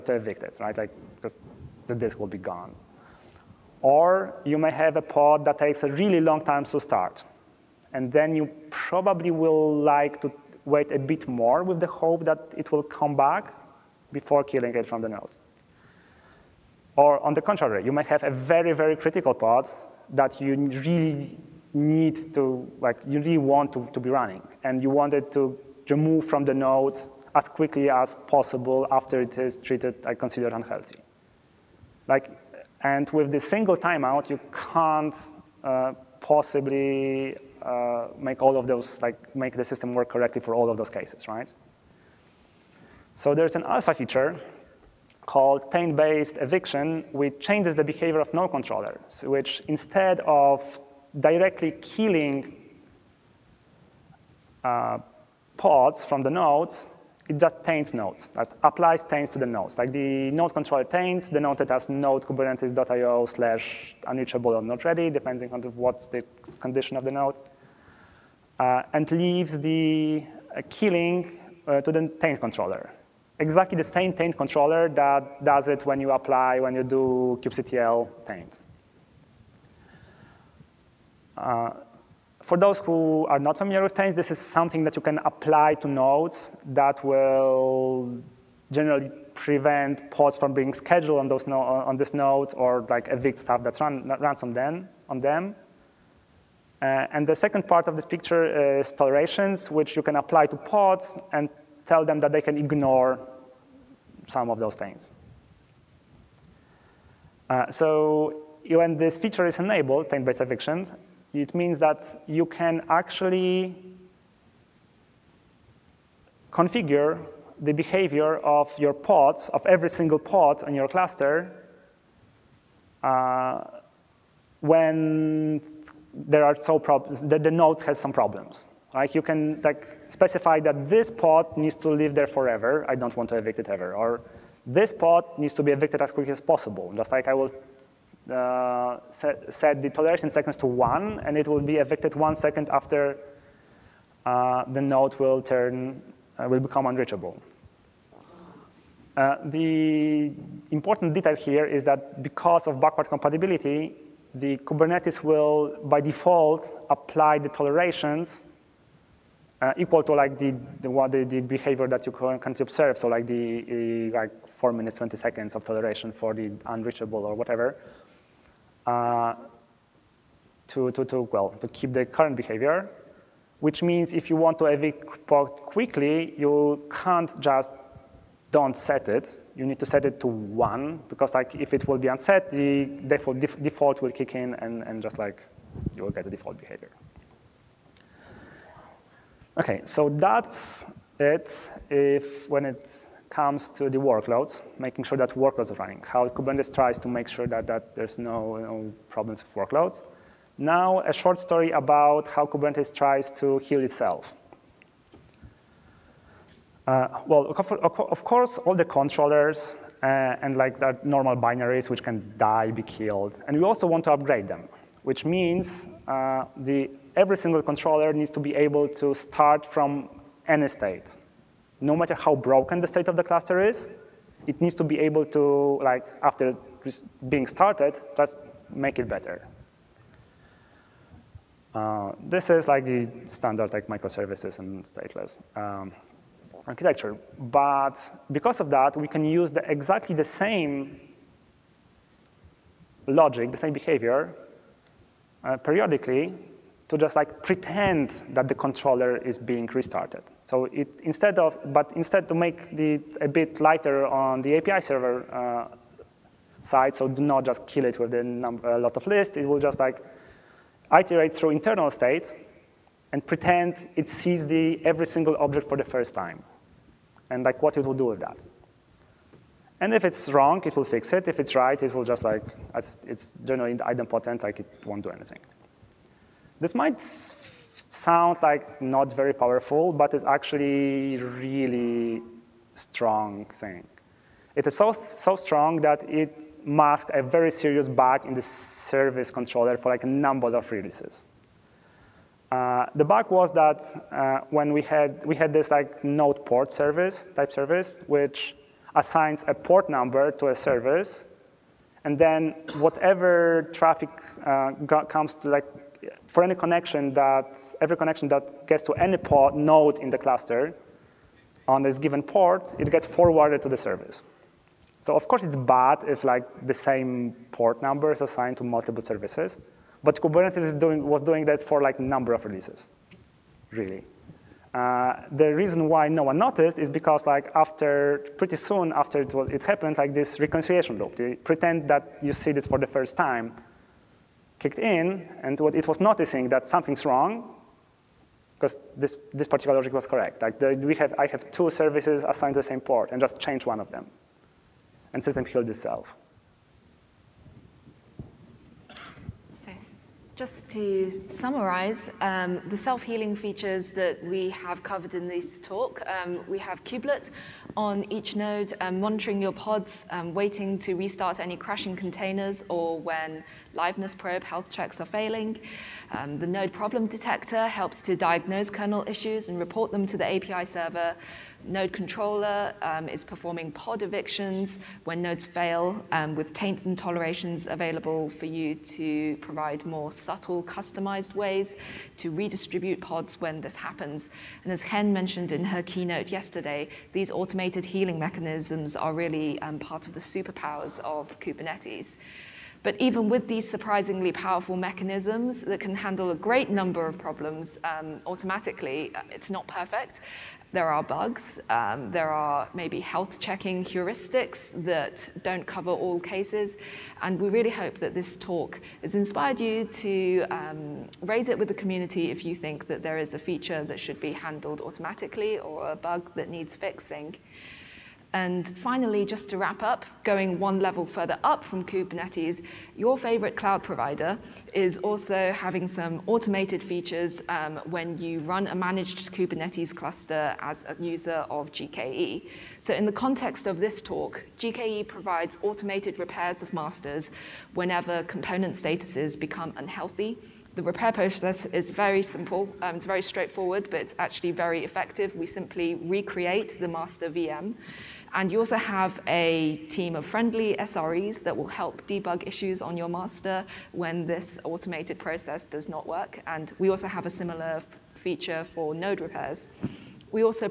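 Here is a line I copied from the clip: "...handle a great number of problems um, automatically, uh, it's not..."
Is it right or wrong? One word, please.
right.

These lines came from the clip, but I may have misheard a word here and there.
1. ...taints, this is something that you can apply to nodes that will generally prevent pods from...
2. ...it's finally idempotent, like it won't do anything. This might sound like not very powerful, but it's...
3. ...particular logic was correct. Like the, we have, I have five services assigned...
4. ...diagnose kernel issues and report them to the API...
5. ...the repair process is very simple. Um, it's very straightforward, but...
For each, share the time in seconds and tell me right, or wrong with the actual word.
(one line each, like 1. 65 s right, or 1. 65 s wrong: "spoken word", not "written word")
1. 83 s right
2. 272 s wrong: "generally", not "finally"
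3. 339 s wrong: "two", not "five"
4. 368 s right
5. 440 s right.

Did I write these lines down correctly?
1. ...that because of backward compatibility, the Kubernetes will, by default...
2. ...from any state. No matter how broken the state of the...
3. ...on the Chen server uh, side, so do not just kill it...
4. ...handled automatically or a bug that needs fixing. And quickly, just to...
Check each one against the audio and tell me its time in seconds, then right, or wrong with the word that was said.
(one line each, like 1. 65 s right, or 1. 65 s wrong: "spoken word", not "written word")
1. 151 s right
2. 219 s right
3. 254 s wrong: "API", not "Chen"
4. 414 s wrong: "finally", not "quickly".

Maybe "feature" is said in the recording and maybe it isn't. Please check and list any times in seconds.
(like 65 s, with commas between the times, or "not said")
43 s, 109 s, 353 s, 413 s, 426 s, 458 s.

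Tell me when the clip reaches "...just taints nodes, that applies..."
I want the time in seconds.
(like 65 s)
57 s.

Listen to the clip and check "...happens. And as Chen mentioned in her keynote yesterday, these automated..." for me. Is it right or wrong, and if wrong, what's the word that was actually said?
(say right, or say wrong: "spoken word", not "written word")
right.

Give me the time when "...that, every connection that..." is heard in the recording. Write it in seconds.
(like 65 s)
307 s.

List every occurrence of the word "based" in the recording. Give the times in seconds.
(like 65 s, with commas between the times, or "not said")
45 s, 110 s.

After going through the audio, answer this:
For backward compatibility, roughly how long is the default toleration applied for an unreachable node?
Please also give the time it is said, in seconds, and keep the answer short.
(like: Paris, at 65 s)
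4 minutes 20 seconds, at 164 s.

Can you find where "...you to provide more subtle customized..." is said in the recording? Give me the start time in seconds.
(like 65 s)
378 s.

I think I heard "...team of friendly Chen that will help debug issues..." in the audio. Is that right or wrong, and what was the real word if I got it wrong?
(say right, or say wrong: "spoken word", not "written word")
wrong: "SREs", not "Chen".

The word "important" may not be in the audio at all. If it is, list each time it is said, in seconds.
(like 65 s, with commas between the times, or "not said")
150 s.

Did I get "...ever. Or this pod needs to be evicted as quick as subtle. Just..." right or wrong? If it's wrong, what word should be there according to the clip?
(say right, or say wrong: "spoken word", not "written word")
wrong: "possible", not "subtle".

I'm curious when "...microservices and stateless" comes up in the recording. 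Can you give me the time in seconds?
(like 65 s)
233 s.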